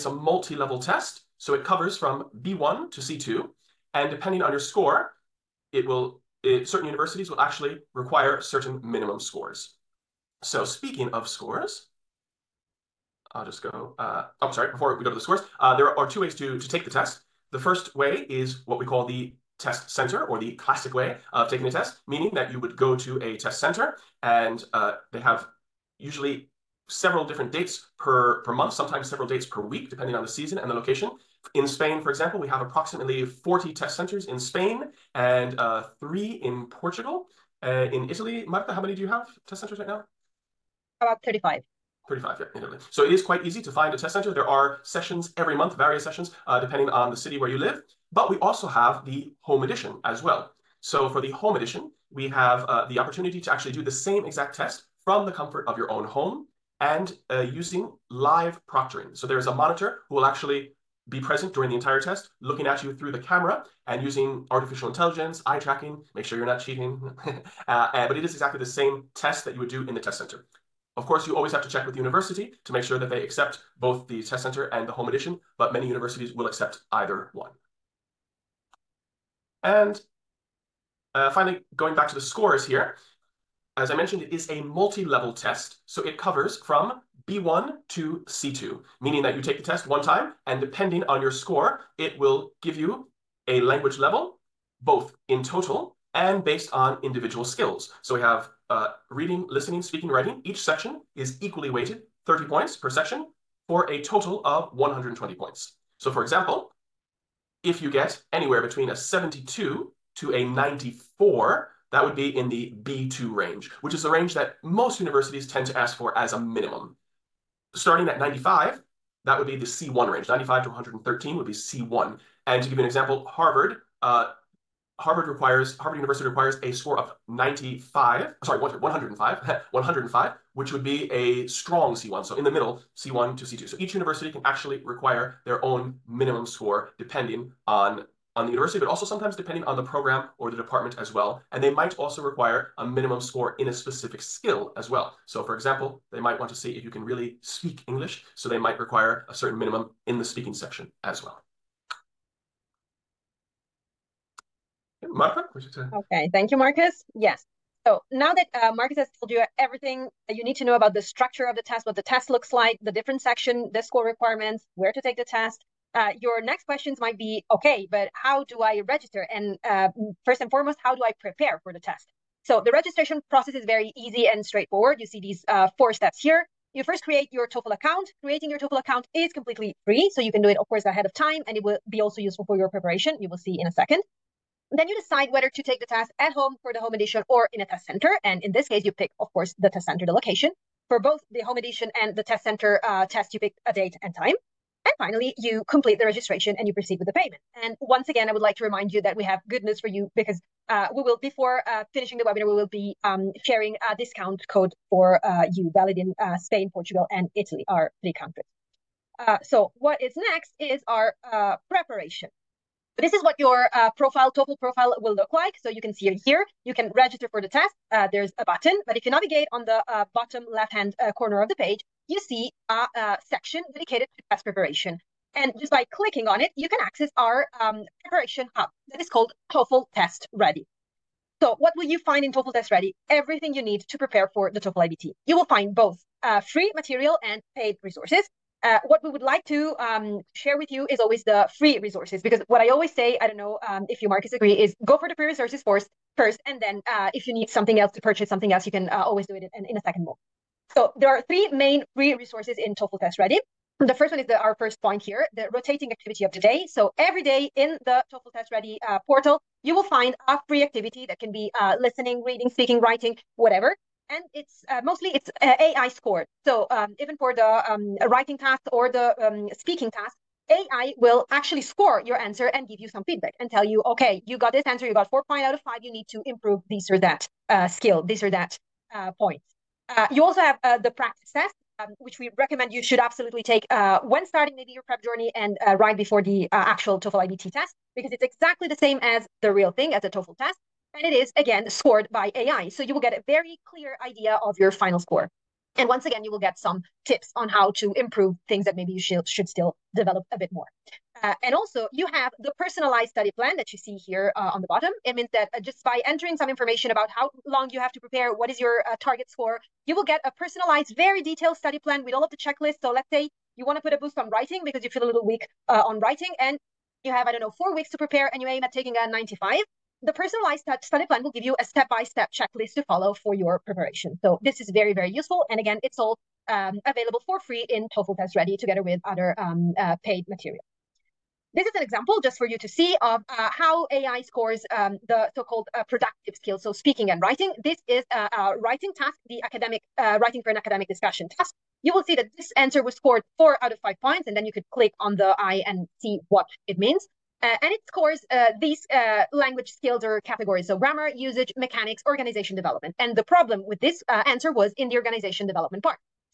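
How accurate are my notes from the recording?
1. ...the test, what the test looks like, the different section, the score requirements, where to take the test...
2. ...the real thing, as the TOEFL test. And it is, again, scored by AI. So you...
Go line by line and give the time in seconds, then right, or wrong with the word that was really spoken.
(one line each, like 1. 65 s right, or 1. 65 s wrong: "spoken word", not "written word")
1. 161 s right
2. 289 s right.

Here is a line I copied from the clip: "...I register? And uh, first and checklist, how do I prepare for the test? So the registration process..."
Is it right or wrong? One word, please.
wrong.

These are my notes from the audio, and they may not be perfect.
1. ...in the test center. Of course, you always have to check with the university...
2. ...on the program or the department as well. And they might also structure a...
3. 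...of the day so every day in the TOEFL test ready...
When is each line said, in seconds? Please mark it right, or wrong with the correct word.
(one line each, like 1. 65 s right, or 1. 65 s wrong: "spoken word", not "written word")
1. 69 s right
2. 139 s wrong: "require", not "structure"
3. 256 s right.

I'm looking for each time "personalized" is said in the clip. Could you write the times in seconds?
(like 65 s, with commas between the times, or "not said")
302 s, 310 s, 320 s.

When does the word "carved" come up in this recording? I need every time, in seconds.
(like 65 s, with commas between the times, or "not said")
not said.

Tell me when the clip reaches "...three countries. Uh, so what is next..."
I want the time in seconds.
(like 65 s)
208 s.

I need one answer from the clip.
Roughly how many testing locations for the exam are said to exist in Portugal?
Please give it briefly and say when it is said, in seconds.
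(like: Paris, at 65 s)
3, at 35 s.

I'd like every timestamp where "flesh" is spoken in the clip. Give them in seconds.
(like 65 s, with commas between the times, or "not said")
not said.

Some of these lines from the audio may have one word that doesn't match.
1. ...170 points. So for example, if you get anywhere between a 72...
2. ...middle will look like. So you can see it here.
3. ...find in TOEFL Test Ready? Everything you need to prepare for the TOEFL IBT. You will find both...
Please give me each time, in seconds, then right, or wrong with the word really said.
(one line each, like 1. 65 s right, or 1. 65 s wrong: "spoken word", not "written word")
1. 104 s wrong: "120", not "170"
2. 214 s wrong: "profile", not "middle"
3. 231 s right.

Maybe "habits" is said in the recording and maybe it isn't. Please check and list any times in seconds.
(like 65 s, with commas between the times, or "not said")
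not said.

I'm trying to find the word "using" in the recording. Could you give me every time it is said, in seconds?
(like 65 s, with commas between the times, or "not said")
57 s, 64 s.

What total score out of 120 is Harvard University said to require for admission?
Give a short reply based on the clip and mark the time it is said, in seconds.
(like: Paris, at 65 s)
105, at 128 s.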